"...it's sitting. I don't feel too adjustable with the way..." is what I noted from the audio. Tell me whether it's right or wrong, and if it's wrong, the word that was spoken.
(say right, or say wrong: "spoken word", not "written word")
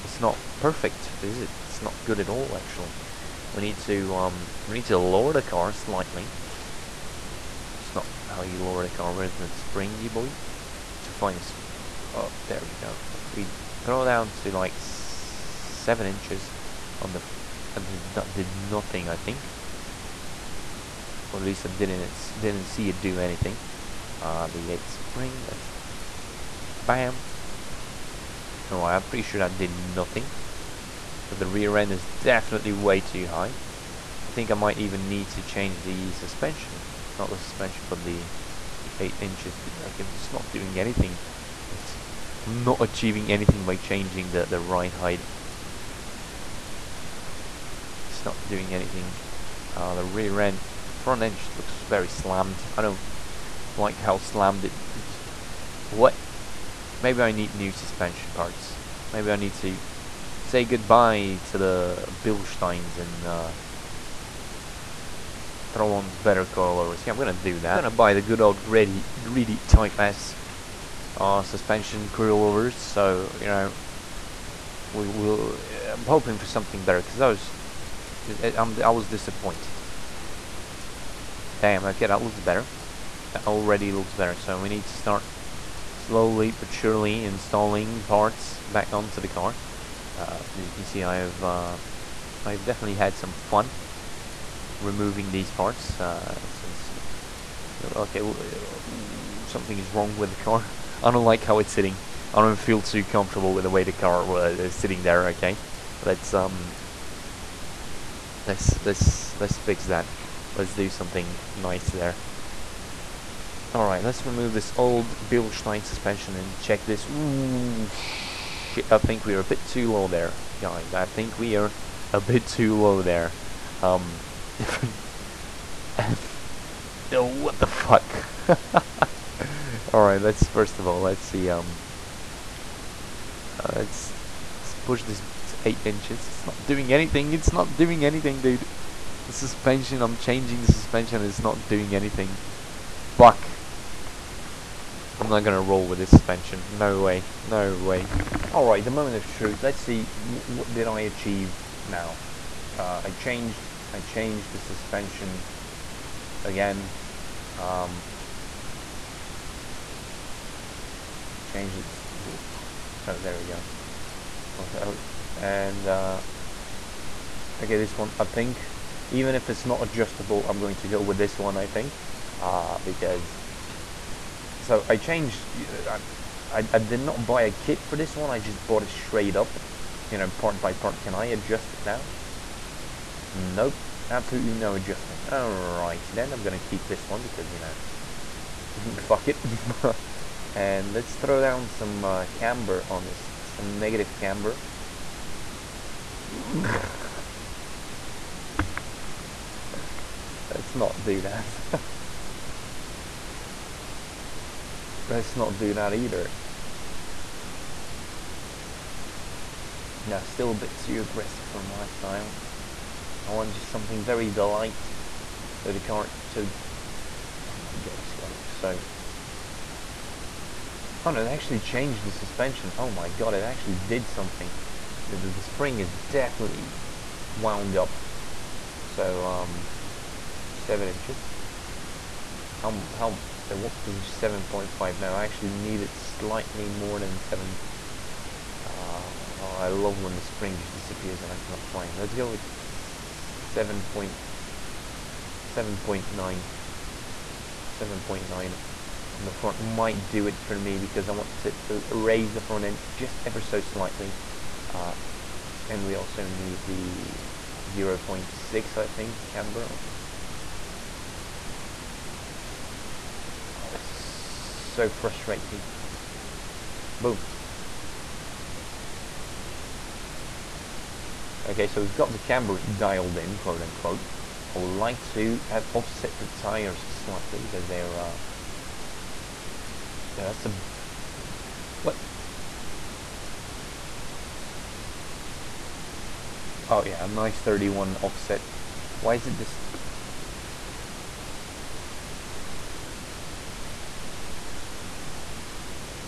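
wrong: "comfortable", not "adjustable".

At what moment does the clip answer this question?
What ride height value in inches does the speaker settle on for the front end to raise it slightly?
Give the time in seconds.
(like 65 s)
247 s.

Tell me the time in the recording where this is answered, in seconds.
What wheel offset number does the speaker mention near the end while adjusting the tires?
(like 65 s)
287 s.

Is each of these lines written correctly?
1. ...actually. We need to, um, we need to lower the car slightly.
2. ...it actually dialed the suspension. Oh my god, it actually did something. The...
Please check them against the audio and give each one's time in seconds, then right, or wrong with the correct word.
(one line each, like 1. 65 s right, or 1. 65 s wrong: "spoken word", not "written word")
1. 2 s right
2. 221 s wrong: "changed", not "dialed".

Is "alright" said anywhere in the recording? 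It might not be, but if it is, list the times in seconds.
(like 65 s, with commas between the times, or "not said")
28 s, 113 s, 129 s, 148 s, 185 s.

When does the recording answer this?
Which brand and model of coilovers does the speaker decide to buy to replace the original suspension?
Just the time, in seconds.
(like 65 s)
69 s.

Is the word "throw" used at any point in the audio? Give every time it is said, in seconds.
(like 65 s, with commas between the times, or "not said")
13 s, 65 s, 191 s.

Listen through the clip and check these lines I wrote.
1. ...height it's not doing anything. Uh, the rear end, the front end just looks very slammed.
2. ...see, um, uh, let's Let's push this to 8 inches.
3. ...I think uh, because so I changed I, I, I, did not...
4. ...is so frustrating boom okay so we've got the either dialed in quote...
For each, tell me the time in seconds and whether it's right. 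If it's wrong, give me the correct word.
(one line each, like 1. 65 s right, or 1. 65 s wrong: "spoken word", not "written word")
1. 44 s right
2. 131 s right
3. 171 s right
4. 263 s wrong: "camber", not "either".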